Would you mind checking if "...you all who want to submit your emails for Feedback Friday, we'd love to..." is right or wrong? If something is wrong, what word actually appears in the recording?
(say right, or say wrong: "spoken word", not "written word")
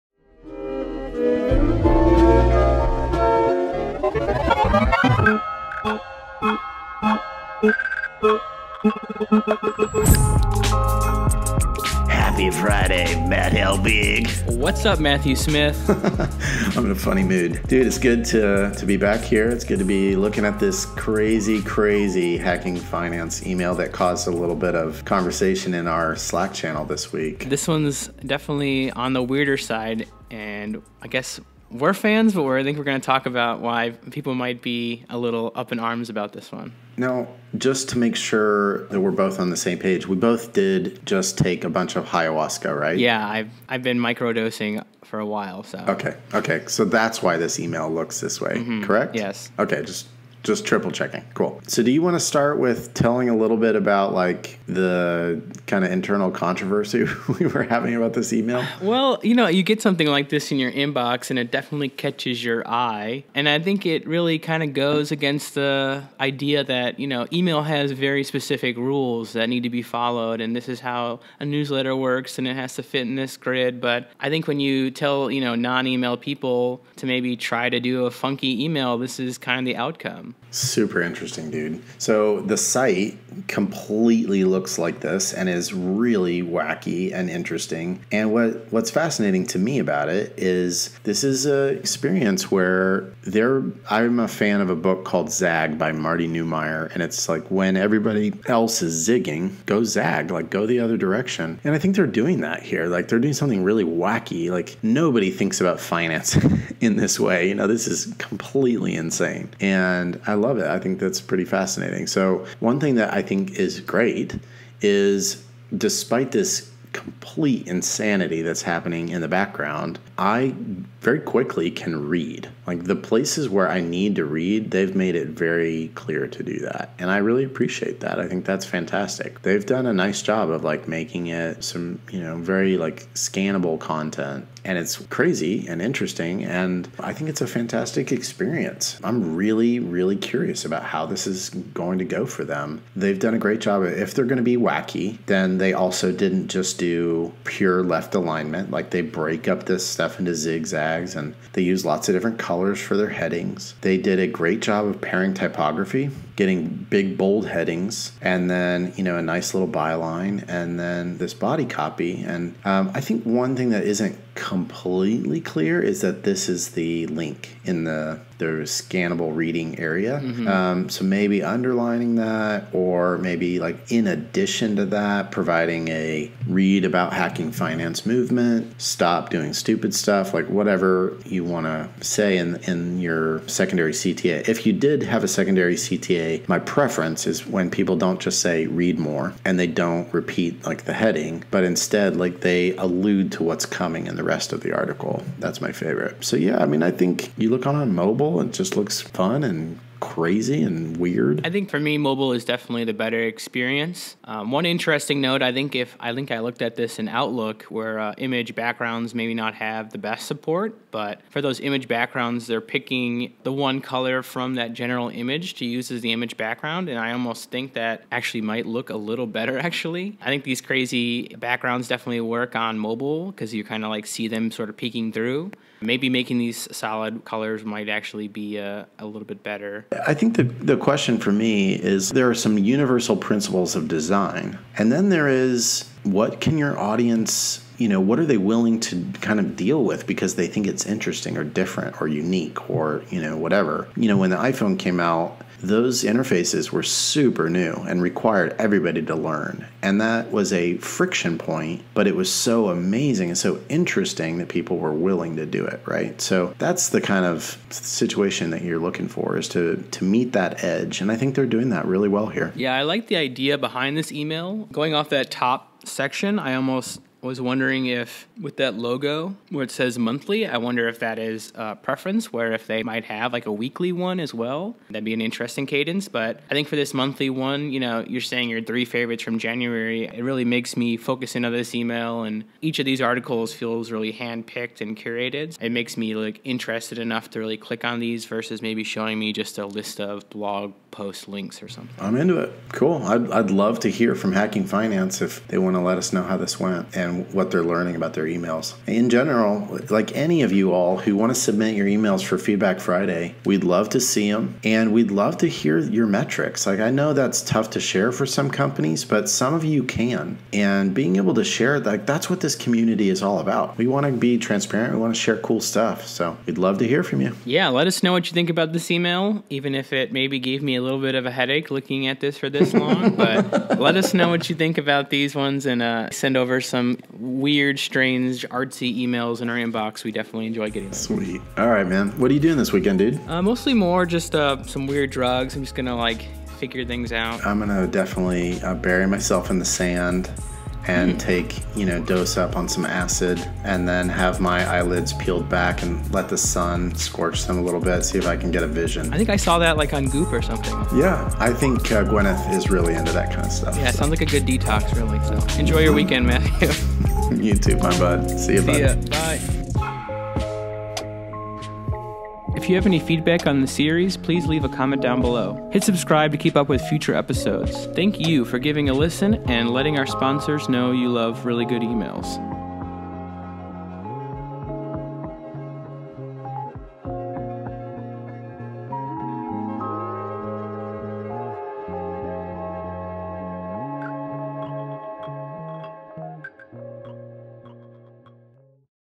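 right.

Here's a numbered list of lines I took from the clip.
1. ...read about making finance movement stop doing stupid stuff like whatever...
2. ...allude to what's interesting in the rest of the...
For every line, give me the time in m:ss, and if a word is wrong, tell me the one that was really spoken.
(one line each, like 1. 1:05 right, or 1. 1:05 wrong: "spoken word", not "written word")
1. 2:56 wrong: "hacking", not "making"
2. 3:12 wrong: "coming", not "interesting".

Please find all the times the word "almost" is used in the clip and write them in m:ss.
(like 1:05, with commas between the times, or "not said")
3:37, 4:26.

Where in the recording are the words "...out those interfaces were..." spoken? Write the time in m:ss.
4:04.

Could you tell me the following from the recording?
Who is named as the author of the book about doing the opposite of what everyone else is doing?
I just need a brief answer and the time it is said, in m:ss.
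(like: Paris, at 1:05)
Marty Neumeier, at 1:35.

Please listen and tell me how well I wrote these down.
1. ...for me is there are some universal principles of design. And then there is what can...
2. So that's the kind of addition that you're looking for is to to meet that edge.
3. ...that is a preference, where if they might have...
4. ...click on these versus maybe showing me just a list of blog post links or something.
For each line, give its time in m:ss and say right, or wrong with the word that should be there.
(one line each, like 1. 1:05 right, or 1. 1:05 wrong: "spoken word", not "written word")
1. 3:51 right
2. 4:16 wrong: "situation", not "addition"
3. 4:30 right
4. 4:47 right.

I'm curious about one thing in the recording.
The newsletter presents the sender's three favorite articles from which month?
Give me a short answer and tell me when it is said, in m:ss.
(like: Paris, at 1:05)
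January, at 4:39.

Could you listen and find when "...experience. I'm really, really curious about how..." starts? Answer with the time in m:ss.
2:18.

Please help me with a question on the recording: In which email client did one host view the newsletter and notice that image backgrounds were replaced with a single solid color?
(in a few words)
Outlook.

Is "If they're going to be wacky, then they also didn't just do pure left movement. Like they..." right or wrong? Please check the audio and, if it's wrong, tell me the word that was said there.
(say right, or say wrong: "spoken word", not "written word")
wrong: "alignment", not "movement".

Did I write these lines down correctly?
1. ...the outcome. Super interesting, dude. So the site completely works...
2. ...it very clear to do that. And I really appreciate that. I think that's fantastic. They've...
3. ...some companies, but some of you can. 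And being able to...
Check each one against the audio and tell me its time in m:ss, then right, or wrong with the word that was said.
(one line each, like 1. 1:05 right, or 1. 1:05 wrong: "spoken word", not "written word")
1. 1:19 wrong: "looks", not "works"
2. 2:05 right
3. 5:08 right.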